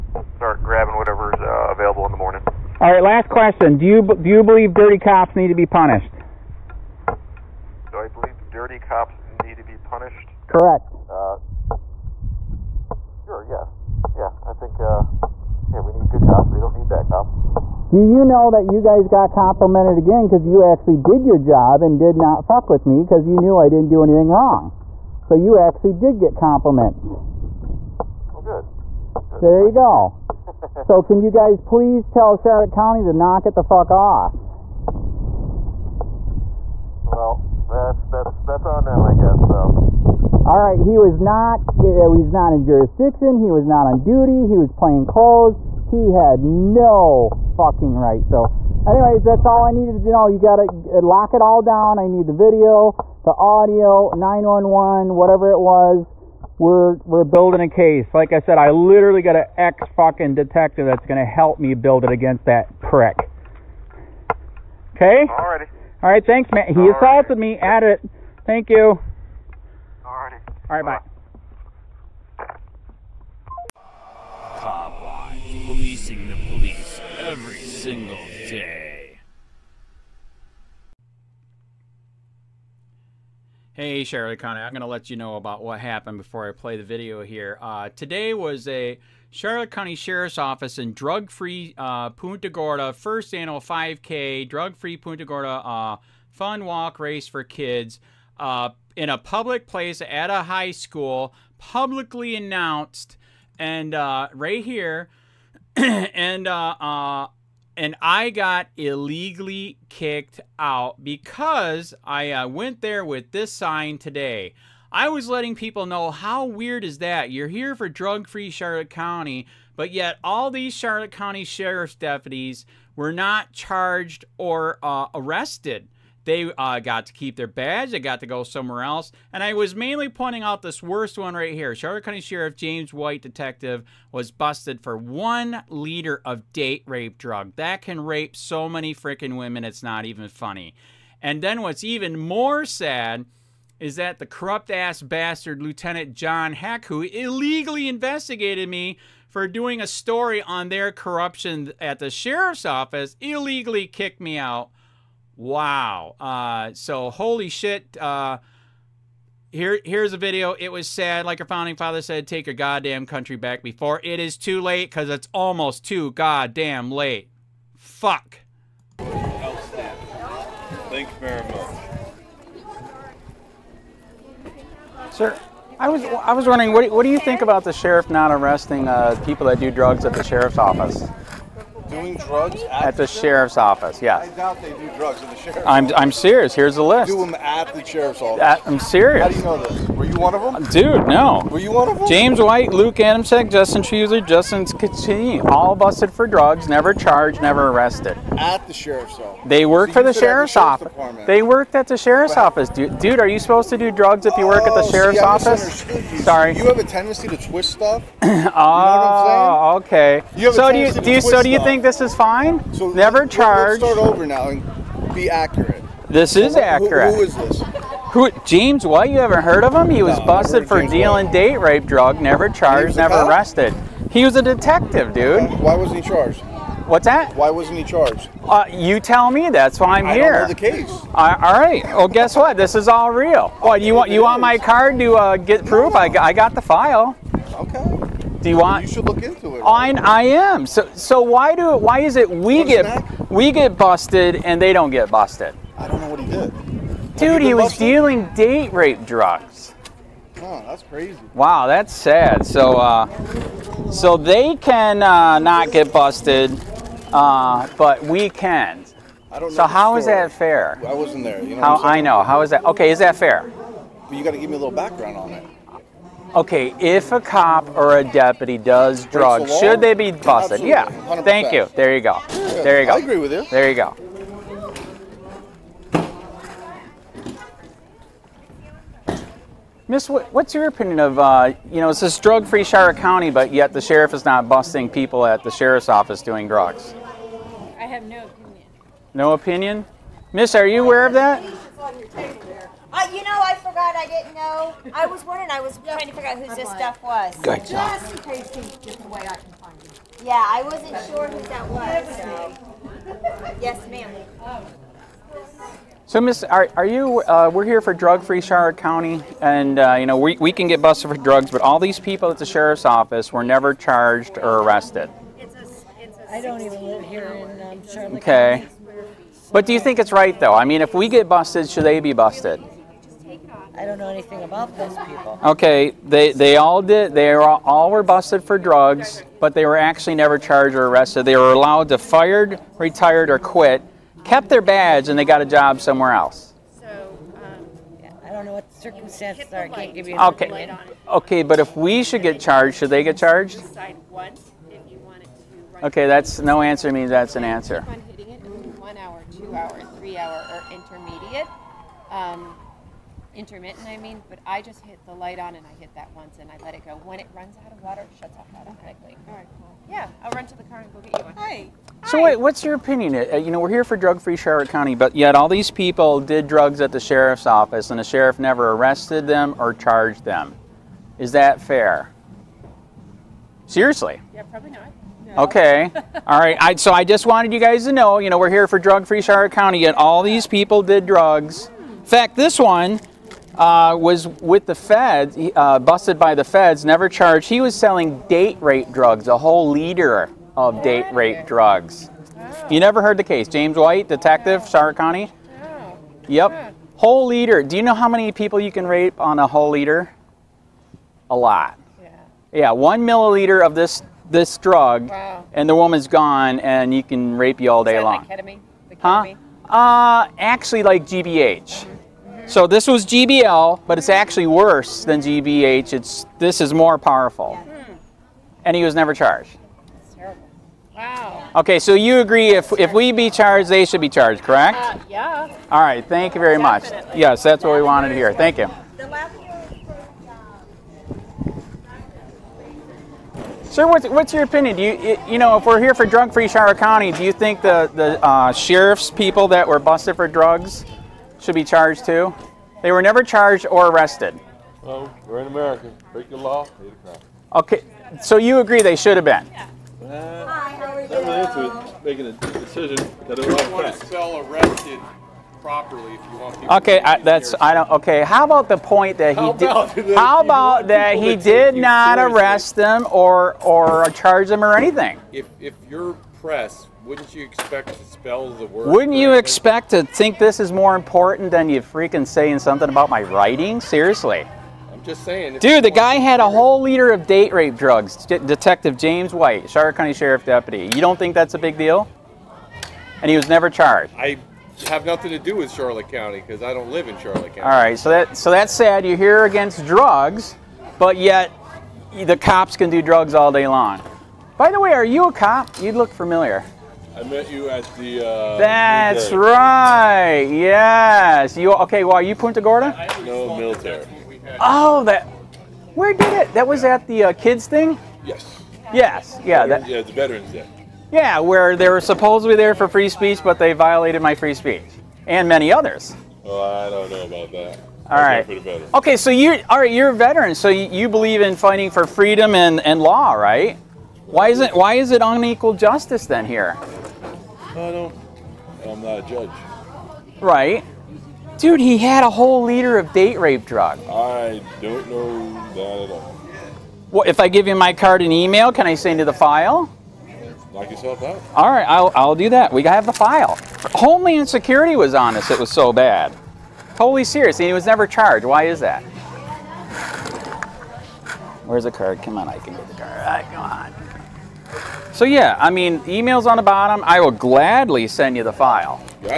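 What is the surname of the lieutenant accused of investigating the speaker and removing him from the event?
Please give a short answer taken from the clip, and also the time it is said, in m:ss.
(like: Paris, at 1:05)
Heck, at 2:26.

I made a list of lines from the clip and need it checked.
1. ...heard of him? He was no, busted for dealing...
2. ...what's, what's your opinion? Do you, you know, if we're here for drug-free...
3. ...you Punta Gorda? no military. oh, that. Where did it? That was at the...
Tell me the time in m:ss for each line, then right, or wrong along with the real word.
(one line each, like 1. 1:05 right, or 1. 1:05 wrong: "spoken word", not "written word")
1. 3:39 right
2. 7:13 right
3. 8:22 right.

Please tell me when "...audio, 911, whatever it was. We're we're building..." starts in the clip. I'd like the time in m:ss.
0:53.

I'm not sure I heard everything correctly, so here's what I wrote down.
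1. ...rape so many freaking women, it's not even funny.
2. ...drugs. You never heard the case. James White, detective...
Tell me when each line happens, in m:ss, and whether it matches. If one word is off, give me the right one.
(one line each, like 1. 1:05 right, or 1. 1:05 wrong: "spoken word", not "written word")
1. 2:18 right
2. 6:31 right.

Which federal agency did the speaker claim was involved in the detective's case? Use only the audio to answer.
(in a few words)
Homeland Security.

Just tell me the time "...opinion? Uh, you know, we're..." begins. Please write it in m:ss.
6:02.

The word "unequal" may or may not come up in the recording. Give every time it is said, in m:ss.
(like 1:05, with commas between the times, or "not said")
8:45.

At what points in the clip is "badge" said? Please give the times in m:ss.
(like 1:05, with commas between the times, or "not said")
2:07, 5:34.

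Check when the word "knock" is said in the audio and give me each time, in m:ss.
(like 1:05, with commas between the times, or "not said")
0:33, 9:00.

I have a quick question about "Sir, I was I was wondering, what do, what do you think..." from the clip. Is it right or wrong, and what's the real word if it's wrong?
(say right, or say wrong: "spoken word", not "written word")
right.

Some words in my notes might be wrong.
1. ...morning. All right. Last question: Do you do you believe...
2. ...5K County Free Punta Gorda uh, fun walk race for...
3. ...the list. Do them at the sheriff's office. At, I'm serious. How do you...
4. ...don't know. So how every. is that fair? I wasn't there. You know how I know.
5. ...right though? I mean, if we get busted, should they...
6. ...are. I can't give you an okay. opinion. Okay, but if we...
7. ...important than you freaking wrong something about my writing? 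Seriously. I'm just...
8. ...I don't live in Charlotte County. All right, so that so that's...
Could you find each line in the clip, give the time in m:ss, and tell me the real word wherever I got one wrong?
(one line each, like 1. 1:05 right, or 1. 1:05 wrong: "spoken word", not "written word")
1. 0:02 right
2. 1:33 wrong: "Drug", not "County"
3. 3:06 right
4. 4:19 wrong: "story", not "every"
5. 5:20 right
6. 5:39 right
7. 7:50 wrong: "saying", not "wrong"
8. 8:06 right.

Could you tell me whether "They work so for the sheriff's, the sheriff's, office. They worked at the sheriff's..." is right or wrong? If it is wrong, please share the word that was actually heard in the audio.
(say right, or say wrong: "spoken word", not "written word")
right.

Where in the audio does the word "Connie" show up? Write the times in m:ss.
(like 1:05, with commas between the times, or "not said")
1:24.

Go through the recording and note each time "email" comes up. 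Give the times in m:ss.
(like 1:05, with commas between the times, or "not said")
8:58, 9:16.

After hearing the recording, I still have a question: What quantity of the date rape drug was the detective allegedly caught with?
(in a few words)
One liter.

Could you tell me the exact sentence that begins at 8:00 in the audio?
You don't think that's a big deal?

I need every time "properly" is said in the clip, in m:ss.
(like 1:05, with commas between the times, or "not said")
7:35.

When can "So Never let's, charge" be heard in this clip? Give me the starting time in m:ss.
3:32.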